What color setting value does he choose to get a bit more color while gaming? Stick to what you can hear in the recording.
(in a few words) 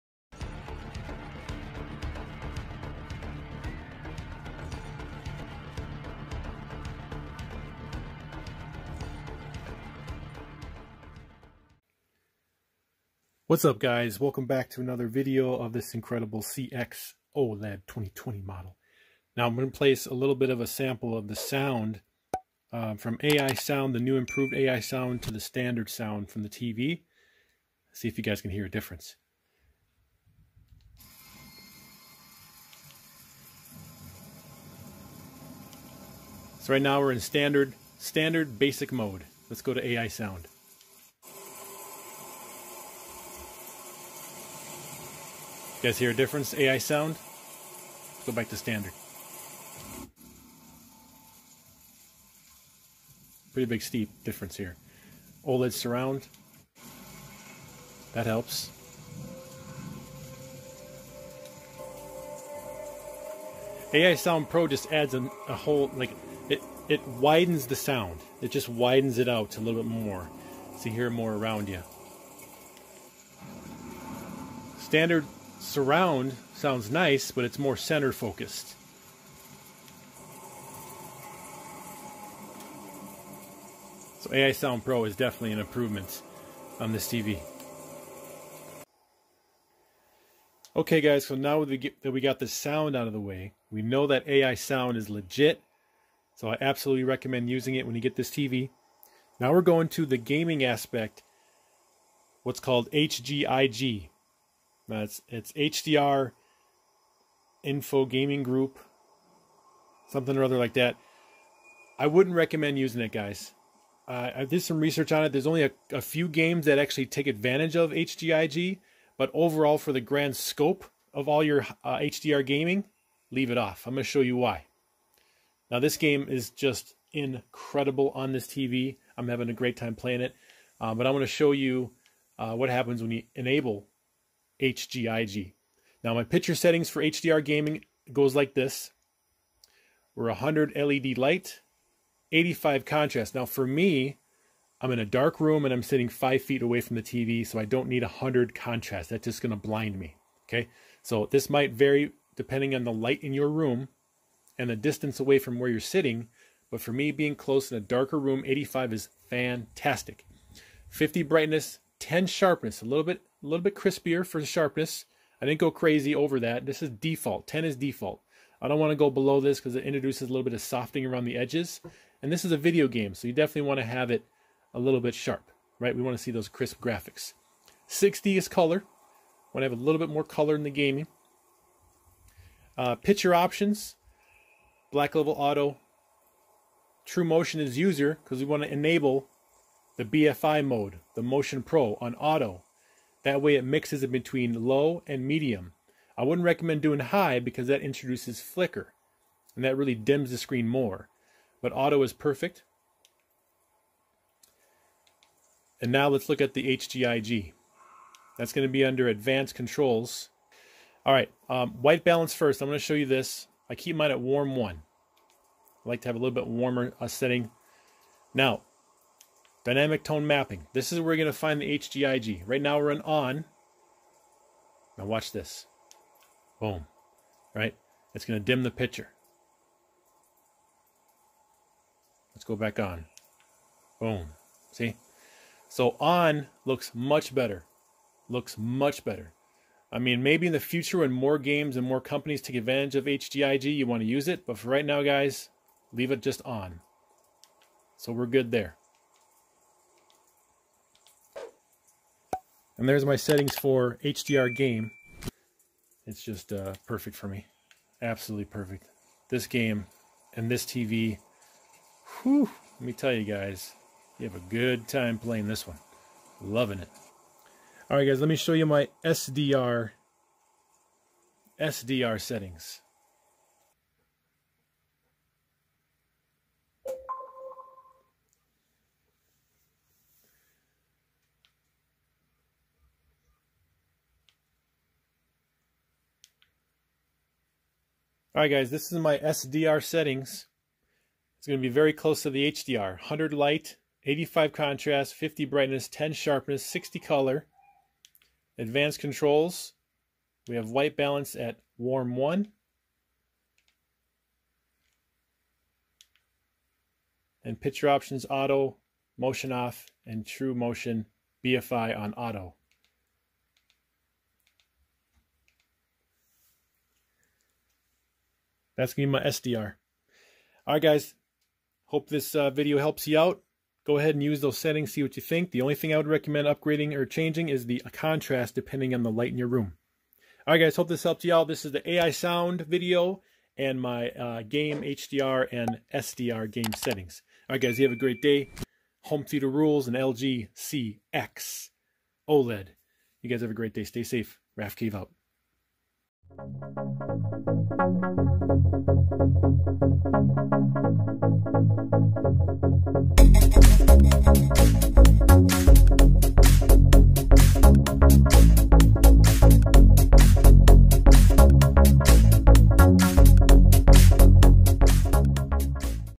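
60.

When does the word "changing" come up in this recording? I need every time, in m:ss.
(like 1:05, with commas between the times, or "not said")
5:27.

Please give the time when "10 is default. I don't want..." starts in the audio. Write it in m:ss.
2:47.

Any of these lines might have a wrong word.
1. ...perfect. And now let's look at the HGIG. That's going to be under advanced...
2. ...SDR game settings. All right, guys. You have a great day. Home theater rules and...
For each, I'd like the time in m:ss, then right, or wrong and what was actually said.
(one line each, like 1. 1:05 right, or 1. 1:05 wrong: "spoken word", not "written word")
1. 3:22 right
2. 5:35 right.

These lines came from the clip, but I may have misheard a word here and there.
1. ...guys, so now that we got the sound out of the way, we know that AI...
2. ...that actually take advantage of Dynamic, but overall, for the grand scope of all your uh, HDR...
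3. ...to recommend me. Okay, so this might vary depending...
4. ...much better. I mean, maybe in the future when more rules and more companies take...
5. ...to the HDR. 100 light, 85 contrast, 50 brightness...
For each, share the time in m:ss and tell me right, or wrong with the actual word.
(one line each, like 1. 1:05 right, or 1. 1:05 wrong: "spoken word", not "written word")
1. 1:31 right
2. 1:56 wrong: "HGIG", not "Dynamic"
3. 2:29 wrong: "blind", not "recommend"
4. 3:58 wrong: "games", not "rules"
5. 4:52 right.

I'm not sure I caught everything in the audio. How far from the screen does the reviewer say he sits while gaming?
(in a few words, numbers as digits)
five feet.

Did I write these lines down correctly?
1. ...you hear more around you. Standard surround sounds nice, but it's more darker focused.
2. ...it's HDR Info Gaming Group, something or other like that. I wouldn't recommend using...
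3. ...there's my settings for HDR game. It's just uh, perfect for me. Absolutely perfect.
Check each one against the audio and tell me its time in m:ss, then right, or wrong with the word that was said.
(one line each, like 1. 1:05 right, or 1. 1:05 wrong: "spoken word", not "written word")
1. 1:10 wrong: "center", not "darker"
2. 1:45 right
3. 4:12 right.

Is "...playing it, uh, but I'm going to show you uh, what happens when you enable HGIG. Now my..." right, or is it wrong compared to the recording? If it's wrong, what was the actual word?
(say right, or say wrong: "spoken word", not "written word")
right.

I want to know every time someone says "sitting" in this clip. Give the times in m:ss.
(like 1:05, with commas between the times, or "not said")
2:25, 2:35.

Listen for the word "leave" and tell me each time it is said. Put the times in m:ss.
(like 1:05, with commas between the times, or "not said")
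2:03, 4:05.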